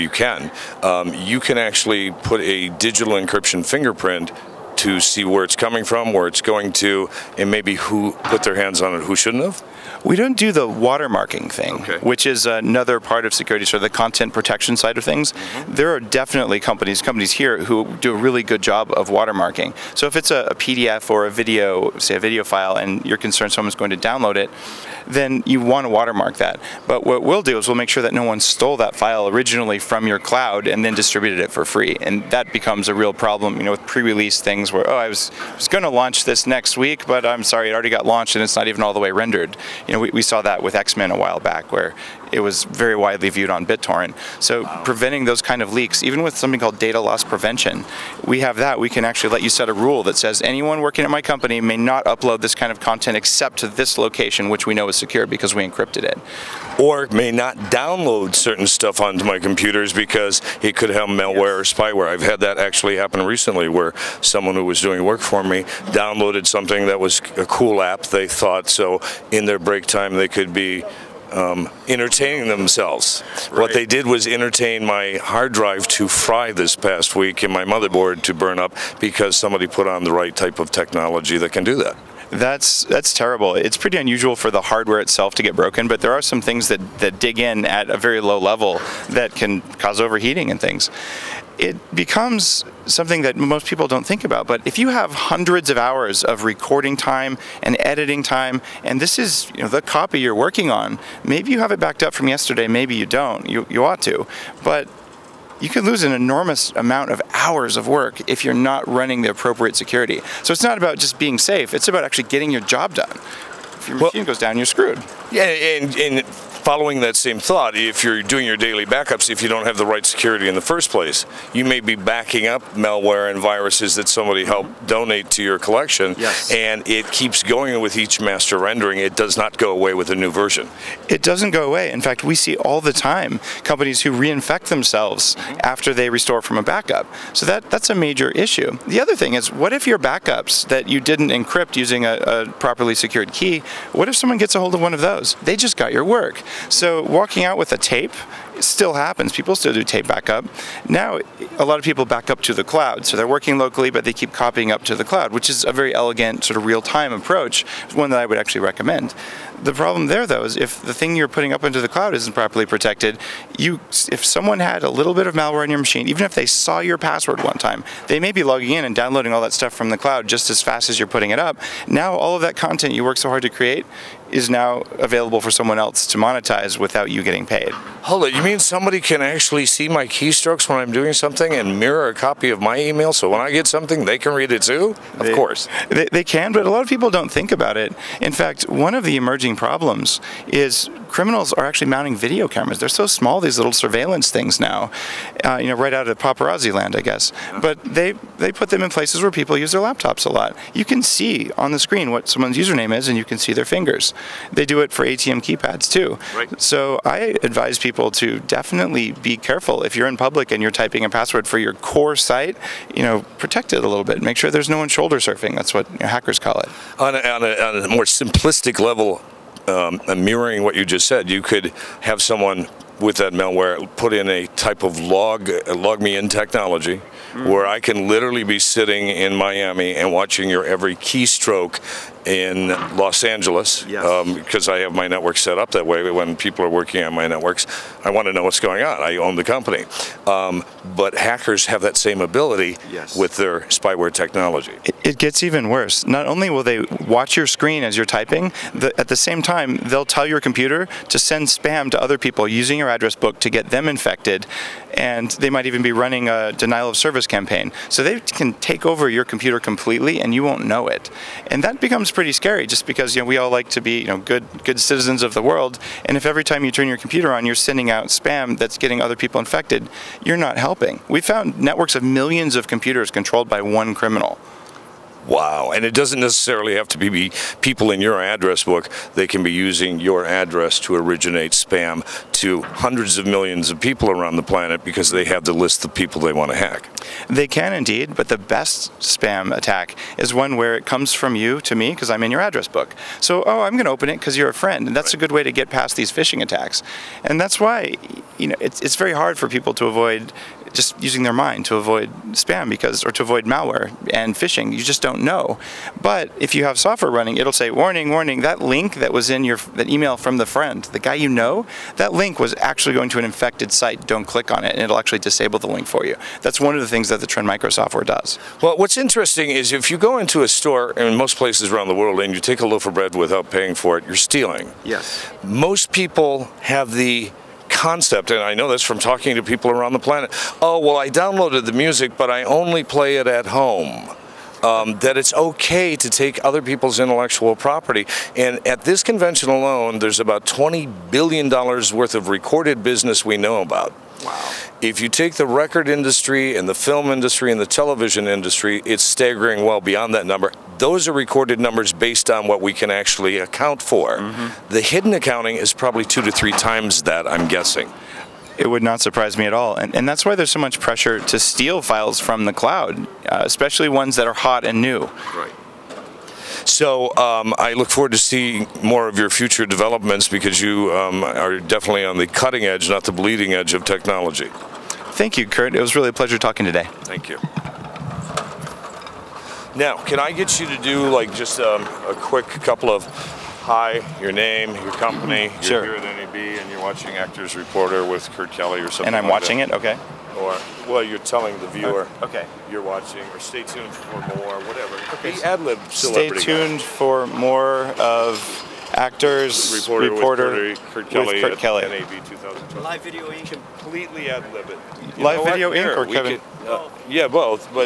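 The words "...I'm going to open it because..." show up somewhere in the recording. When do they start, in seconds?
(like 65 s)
293 s.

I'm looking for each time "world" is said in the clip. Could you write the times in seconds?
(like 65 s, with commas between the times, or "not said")
265 s, 321 s.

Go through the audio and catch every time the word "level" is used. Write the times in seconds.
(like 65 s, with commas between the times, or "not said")
88 s, 218 s.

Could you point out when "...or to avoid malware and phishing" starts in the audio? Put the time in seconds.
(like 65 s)
303 s.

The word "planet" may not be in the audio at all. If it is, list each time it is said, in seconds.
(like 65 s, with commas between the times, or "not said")
284 s, 329 s.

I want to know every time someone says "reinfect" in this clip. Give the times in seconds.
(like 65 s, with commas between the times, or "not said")
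134 s.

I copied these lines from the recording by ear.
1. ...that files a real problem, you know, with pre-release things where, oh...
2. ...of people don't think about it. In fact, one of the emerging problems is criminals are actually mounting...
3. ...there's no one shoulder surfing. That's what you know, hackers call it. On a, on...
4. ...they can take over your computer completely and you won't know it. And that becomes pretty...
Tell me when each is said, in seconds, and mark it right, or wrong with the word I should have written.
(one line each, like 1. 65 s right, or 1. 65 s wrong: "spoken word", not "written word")
1. 32 s wrong: "becomes", not "files"
2. 186 s right
3. 214 s right
4. 258 s right.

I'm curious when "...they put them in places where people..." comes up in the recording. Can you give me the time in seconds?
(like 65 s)
198 s.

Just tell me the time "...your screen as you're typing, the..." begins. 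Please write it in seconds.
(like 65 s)
247 s.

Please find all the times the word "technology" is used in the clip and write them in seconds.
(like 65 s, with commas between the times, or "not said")
80 s, 226 s, 244 s, 373 s.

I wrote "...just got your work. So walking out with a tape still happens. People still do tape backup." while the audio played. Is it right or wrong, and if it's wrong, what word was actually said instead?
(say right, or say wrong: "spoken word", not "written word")
right.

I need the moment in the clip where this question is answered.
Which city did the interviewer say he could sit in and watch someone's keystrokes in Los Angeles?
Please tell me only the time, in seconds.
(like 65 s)
229 s.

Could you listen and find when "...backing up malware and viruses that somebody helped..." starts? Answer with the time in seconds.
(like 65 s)
121 s.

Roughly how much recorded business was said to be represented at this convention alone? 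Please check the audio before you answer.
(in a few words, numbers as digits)
$20 billion.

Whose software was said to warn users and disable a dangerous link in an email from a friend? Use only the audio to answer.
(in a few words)
Trend Micro.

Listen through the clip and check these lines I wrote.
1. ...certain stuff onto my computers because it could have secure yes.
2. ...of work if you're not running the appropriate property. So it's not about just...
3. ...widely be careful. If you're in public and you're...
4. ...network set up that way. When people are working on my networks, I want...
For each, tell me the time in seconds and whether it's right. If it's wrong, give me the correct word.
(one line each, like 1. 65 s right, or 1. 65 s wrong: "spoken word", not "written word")
1. 58 s wrong: "malware", not "secure"
2. 107 s wrong: "security", not "property"
3. 208 s wrong: "definitely", not "widely"
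4. 235 s right.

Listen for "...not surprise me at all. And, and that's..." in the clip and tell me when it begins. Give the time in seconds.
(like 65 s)
358 s.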